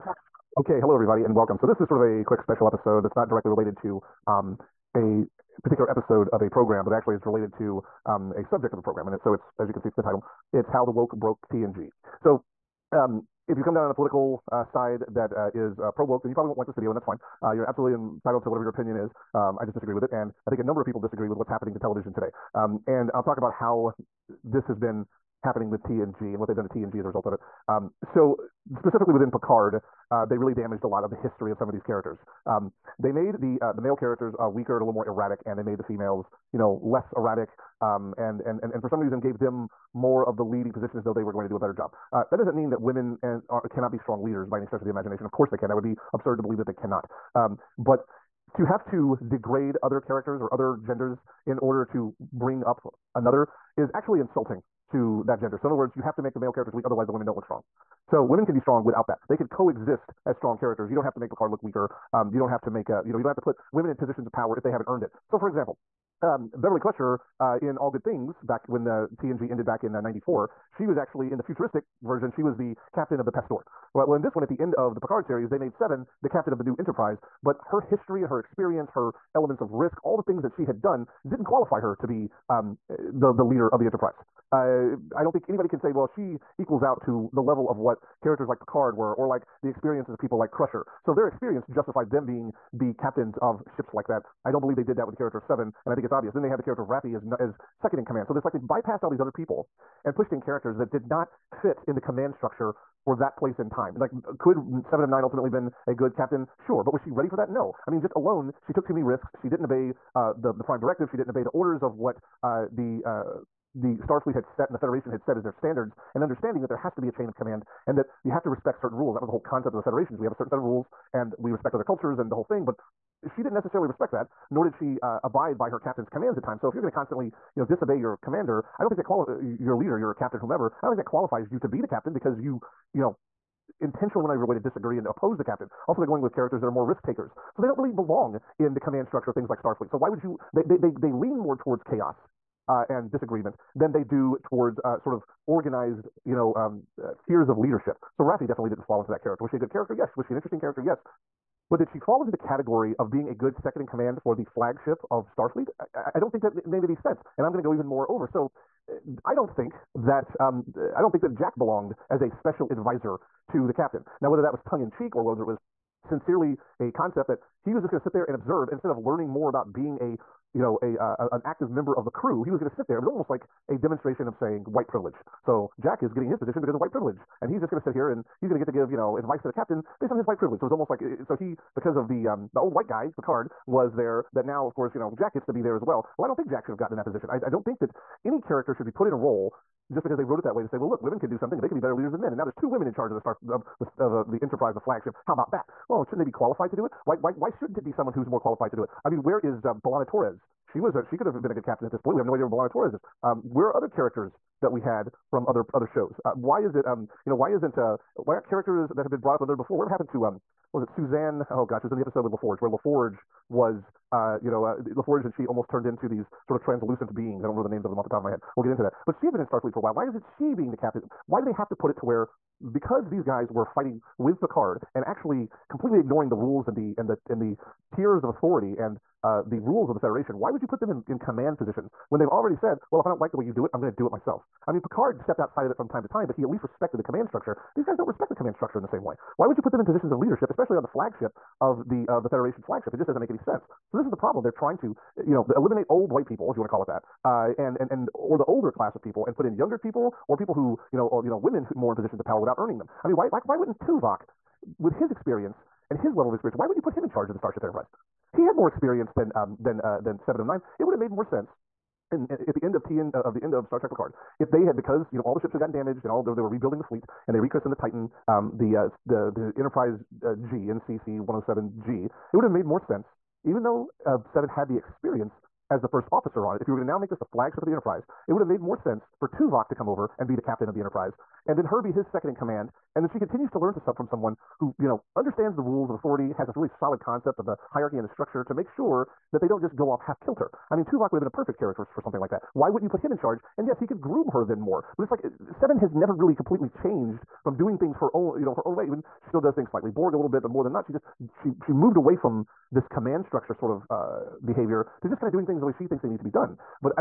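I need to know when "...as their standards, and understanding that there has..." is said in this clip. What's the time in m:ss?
1:55.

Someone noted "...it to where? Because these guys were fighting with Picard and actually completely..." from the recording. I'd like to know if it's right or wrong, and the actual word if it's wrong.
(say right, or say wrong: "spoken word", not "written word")
right.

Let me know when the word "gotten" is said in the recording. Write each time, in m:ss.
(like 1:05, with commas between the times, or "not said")
3:06, 4:25.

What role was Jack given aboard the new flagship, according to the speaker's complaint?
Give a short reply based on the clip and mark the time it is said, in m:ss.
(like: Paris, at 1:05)
special advisor, at 2:42.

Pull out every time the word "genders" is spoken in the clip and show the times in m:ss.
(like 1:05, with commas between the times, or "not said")
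0:50, 0:55.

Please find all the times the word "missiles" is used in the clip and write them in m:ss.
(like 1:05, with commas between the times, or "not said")
not said.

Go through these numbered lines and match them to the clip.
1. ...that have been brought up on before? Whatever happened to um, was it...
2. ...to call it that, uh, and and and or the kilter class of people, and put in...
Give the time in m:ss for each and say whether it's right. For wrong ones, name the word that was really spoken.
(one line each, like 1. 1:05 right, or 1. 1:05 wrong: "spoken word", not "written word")
1. 3:28 right
2. 4:06 wrong: "older", not "kilter".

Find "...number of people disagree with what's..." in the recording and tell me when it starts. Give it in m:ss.
0:20.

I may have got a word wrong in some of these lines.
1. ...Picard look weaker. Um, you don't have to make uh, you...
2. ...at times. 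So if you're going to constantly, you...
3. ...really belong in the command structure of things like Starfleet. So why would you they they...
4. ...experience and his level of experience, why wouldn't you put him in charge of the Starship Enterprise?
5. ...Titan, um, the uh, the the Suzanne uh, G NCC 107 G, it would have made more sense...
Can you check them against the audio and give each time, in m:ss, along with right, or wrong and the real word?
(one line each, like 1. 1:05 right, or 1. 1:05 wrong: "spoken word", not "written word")
1. 1:01 right
2. 2:06 right
3. 2:17 right
4. 4:15 right
5. 4:27 wrong: "Enterprise", not "Suzanne".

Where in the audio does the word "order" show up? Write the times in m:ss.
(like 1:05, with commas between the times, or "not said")
0:51, 1:51.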